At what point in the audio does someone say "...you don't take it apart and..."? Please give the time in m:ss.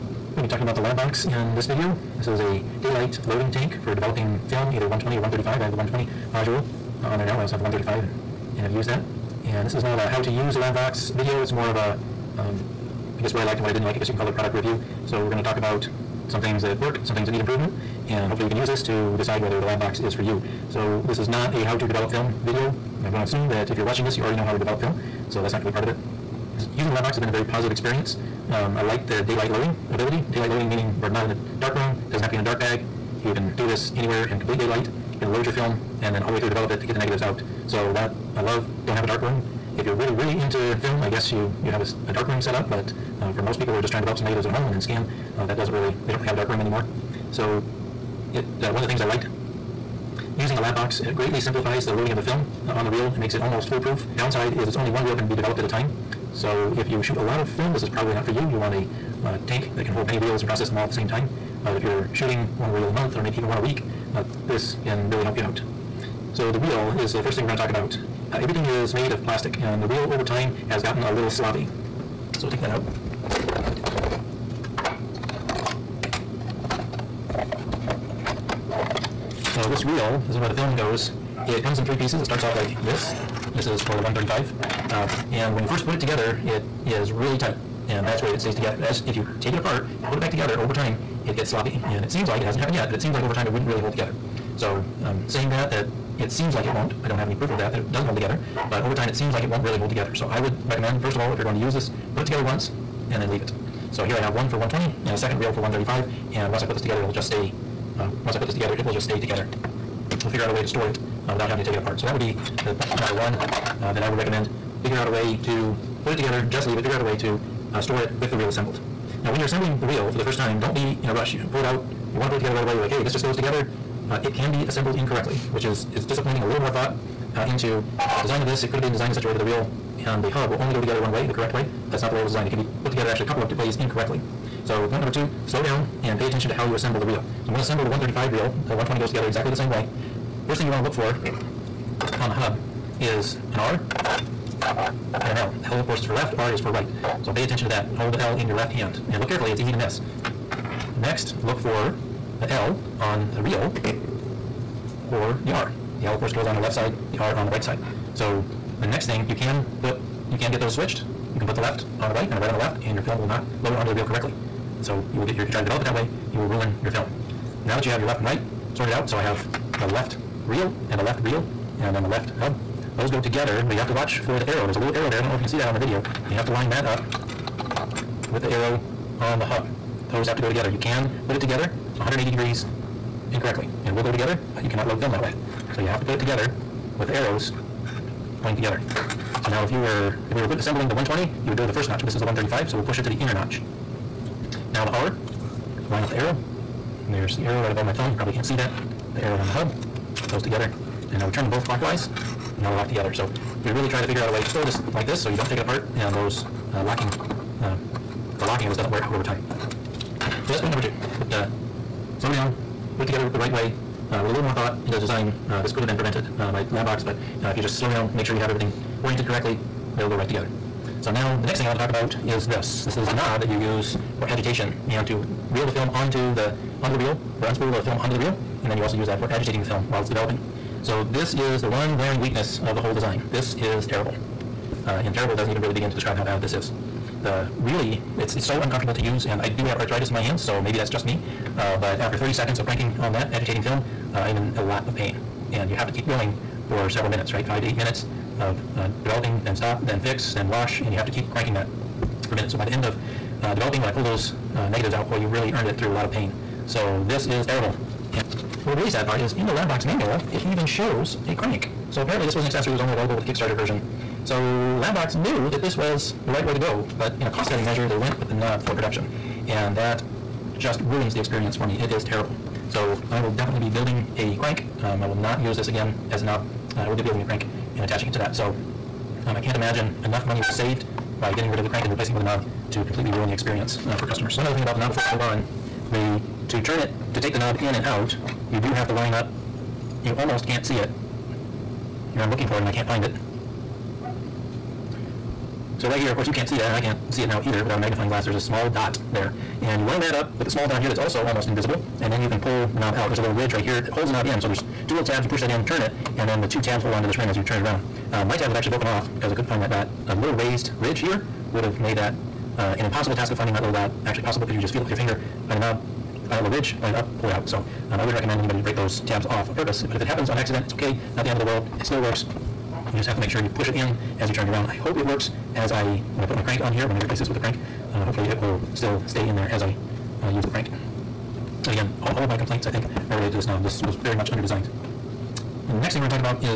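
3:25.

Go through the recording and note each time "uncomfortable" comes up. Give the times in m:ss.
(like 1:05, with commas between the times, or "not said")
3:58.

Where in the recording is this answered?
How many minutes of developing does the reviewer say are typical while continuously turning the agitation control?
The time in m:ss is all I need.
4:07.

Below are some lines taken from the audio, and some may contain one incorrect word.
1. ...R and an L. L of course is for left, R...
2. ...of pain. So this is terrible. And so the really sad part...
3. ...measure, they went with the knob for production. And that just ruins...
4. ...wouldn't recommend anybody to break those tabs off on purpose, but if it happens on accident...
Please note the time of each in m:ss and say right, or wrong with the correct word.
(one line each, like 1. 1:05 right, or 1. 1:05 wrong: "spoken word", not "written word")
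1. 2:23 right
2. 4:16 right
3. 4:27 right
4. 5:18 right.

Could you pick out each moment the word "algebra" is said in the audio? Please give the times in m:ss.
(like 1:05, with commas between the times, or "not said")
not said.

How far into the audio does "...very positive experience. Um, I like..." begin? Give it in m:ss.
0:27.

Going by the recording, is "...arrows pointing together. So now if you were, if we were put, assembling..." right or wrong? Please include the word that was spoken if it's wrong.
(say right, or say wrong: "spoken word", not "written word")
right.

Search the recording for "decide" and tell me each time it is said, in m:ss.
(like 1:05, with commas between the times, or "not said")
0:19.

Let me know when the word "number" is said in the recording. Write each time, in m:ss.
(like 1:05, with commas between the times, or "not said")
1:53, 2:15, 3:30.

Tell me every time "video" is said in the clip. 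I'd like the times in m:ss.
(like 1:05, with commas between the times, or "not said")
0:01, 0:11, 0:22, 2:55.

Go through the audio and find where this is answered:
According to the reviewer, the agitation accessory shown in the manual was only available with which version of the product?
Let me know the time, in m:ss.
4:23.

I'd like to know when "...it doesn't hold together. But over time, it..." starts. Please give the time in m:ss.
1:37.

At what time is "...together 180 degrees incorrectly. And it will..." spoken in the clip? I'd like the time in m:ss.
3:01.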